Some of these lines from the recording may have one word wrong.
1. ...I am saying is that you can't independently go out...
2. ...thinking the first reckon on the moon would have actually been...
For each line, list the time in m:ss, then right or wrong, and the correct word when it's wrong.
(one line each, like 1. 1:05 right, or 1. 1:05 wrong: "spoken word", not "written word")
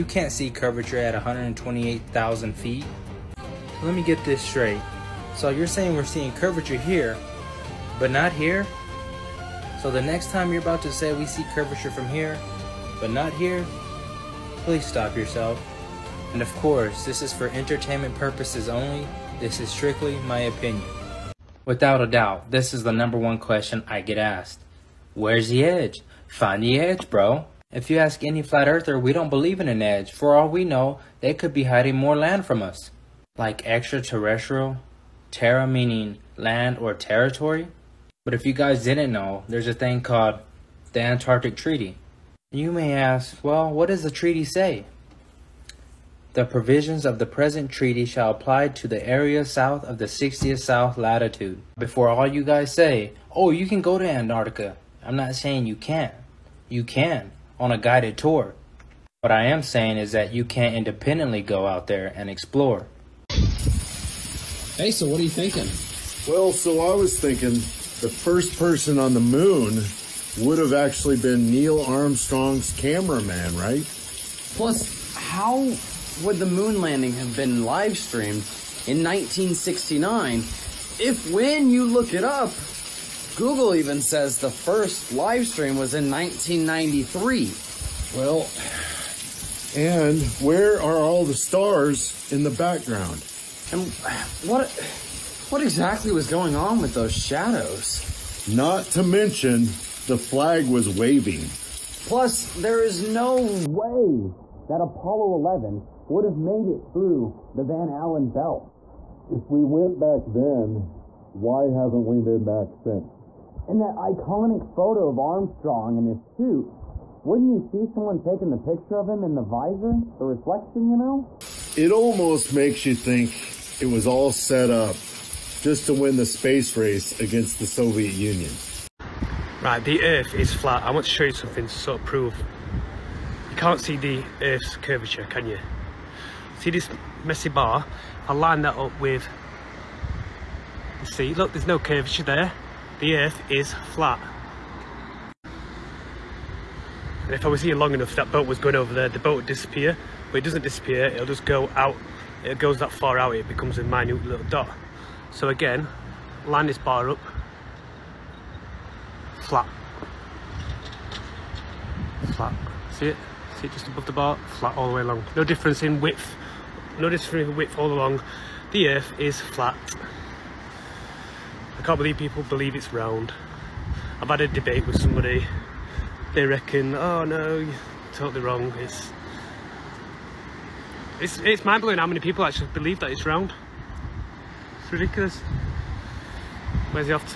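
1. 0:59 right
2. 1:07 wrong: "person", not "reckon".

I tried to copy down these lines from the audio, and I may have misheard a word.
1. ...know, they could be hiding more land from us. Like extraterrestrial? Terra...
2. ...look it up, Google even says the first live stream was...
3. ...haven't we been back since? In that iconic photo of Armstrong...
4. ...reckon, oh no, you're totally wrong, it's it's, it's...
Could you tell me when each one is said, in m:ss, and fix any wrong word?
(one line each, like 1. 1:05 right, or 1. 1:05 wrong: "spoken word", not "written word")
1. 0:30 right
2. 1:21 right
3. 1:51 right
4. 2:56 right.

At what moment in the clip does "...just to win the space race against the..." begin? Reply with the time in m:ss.
2:05.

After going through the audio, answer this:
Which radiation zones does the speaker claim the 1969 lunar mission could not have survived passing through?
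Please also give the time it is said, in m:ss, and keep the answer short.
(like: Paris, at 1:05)
Van Allen belts, at 1:47.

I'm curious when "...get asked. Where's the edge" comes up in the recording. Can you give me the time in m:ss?
0:23.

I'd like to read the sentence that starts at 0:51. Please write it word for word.
Before all you guys say, oh, you can go to Antarctica.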